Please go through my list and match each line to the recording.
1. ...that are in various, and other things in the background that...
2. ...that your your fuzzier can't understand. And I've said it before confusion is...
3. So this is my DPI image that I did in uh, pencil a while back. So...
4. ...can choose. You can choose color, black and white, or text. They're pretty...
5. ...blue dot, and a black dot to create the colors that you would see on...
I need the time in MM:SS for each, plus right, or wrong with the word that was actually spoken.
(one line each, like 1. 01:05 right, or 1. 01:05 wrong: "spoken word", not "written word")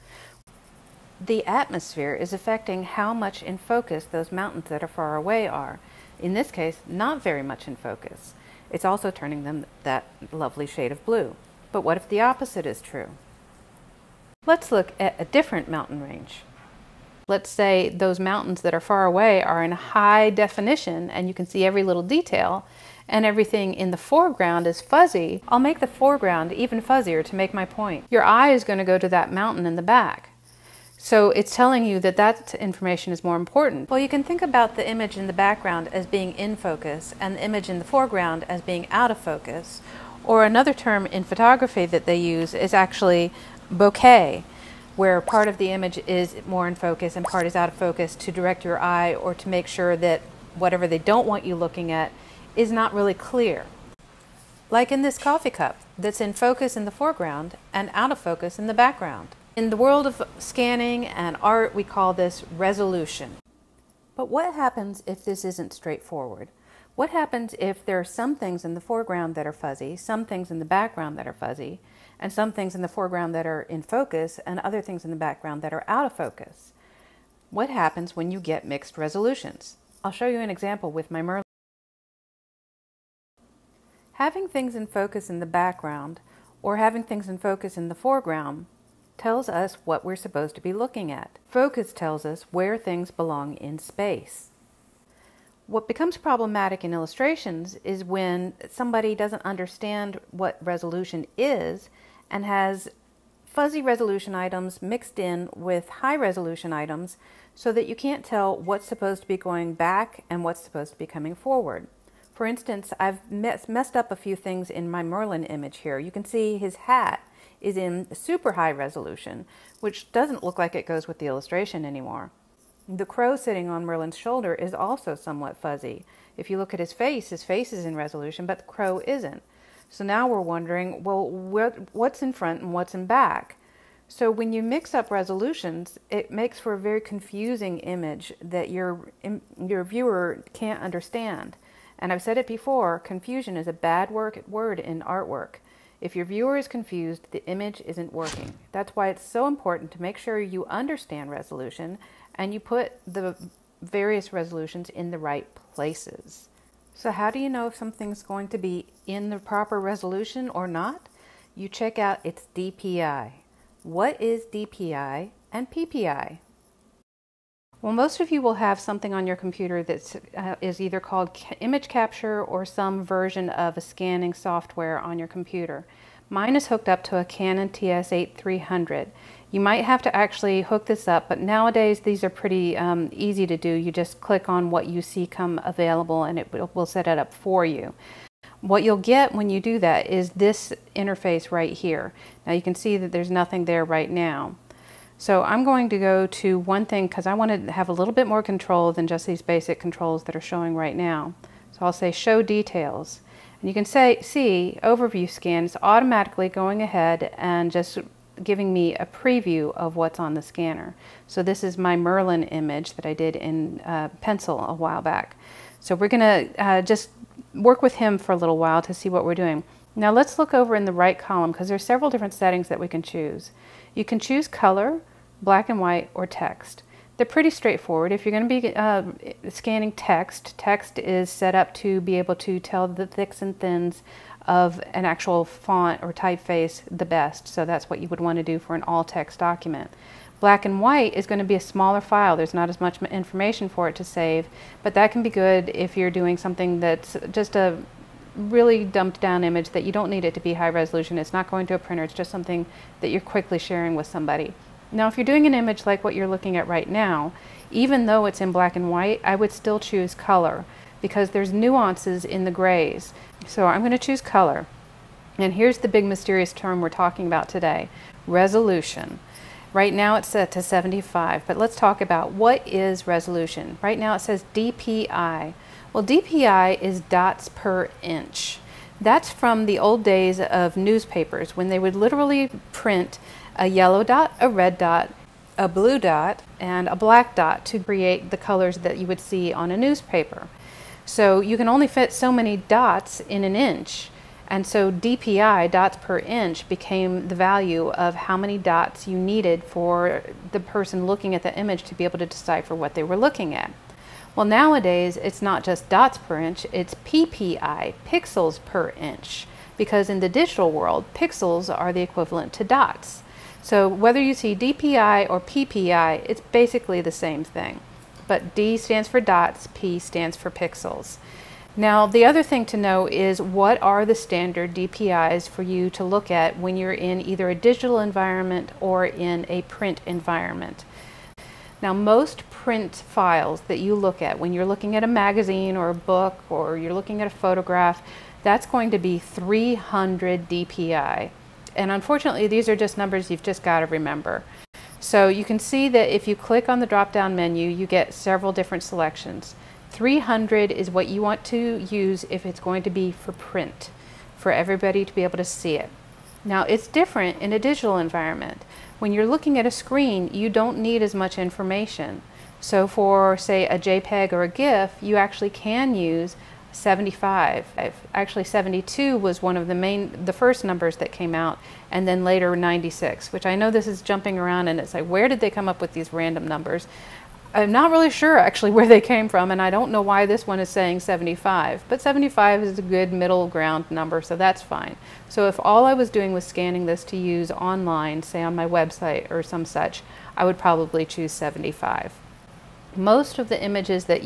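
1. 01:13 wrong: "focus", not "various"
2. 02:18 wrong: "viewer", not "fuzzier"
3. 03:31 wrong: "Merlin", not "DPI"
4. 03:42 right
5. 04:45 right.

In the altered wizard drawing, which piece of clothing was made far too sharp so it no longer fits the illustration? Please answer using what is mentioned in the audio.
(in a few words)
his hat.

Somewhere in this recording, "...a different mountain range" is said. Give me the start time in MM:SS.
00:15.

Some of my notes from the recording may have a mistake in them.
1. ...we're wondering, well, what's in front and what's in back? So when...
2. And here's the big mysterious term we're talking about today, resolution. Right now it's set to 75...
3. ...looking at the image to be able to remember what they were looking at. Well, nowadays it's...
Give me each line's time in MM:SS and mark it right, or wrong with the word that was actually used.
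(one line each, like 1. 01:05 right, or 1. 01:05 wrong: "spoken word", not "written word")
1. 02:10 right
2. 04:25 right
3. 05:01 wrong: "decipher", not "remember".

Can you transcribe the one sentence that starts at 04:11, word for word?
It's not going to a printer.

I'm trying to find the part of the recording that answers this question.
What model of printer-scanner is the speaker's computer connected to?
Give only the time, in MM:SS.
02:57.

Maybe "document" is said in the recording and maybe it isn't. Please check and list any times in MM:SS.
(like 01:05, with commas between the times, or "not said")
03:59.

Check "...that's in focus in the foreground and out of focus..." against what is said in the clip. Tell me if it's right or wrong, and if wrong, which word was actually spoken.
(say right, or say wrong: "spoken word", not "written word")
right.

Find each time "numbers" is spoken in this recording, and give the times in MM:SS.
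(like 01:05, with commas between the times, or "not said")
05:42, 06:10, 06:16, 06:23.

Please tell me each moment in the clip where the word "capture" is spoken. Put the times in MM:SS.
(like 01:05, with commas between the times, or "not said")
02:51.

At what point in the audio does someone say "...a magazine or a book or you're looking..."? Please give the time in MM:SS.
05:35.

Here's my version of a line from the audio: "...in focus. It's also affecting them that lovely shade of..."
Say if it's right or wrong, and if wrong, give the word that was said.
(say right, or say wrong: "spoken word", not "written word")
wrong: "turning", not "affecting".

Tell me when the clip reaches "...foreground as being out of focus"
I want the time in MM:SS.
00:37.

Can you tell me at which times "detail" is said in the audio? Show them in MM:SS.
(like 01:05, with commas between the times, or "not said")
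00:22, 03:22.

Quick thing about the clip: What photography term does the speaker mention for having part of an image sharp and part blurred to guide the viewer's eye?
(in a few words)
bokeh.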